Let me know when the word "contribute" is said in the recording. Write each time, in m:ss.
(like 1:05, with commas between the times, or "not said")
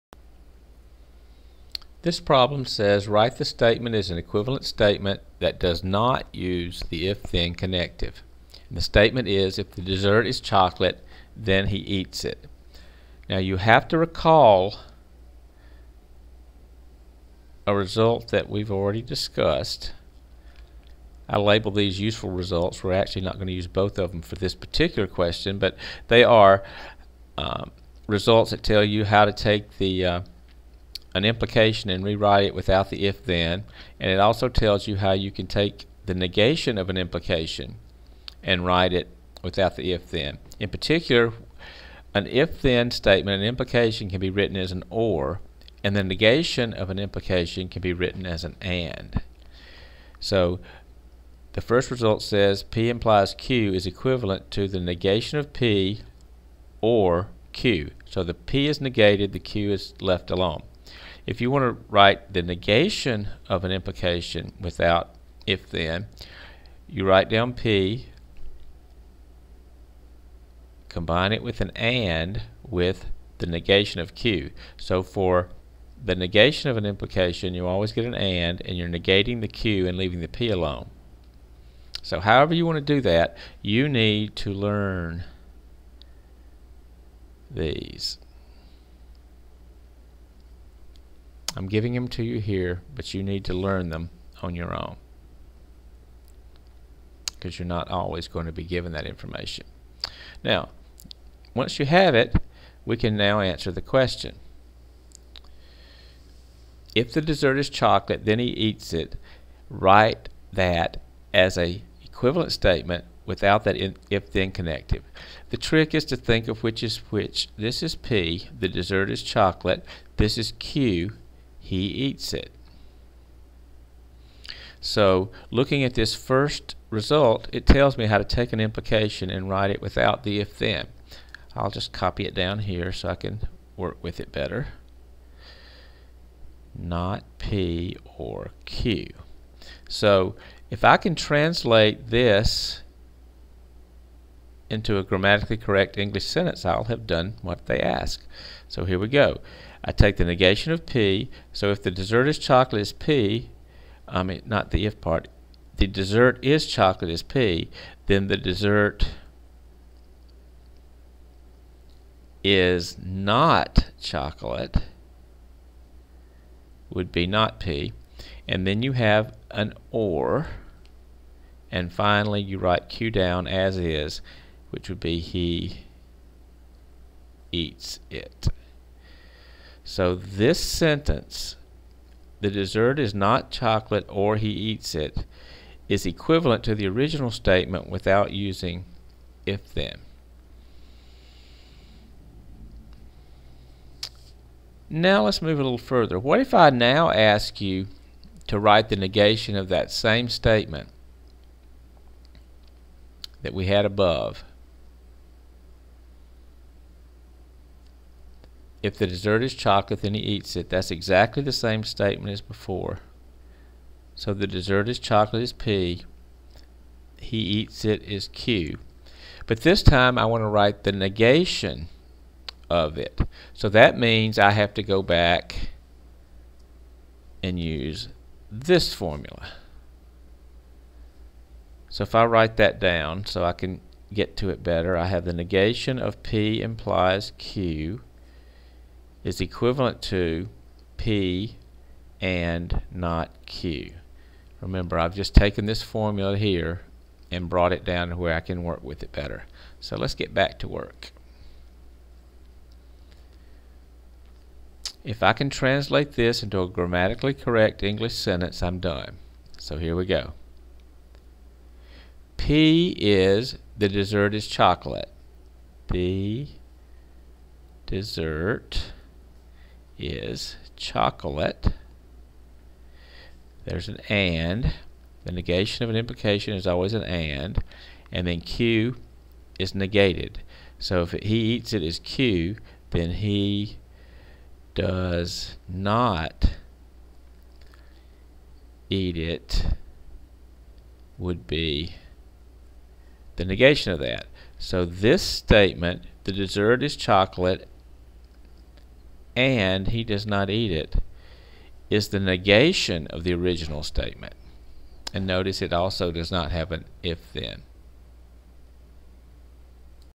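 not said.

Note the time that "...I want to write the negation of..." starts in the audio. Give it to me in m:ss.
3:40.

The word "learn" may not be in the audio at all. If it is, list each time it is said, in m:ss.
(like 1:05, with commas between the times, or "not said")
1:24, 1:33.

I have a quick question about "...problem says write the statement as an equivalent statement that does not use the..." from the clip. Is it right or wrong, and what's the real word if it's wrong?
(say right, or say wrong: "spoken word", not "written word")
right.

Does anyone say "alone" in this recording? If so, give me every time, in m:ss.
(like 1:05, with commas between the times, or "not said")
1:00, 1:20.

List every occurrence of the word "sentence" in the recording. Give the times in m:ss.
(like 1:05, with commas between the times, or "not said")
2:26, 3:00, 4:18.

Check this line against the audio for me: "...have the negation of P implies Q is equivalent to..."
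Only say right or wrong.
right.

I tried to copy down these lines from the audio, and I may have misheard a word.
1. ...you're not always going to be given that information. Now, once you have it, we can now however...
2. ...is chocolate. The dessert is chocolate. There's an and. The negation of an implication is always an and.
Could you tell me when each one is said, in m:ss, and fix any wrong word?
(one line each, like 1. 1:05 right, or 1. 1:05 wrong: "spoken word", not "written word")
1. 1:37 wrong: "answer", not "however"
2. 4:24 right.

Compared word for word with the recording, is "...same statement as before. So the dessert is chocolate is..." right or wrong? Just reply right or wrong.
right.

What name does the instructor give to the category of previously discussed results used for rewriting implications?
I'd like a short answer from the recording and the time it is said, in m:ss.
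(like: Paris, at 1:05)
useful results, at 0:21.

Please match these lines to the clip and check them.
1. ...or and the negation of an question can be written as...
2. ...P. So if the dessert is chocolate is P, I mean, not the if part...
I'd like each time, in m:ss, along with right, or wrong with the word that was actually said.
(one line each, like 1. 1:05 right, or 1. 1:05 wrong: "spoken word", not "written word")
1. 0:44 wrong: "implication", not "question"
2. 2:30 right.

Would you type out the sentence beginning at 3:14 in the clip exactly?
Now let's move a little further.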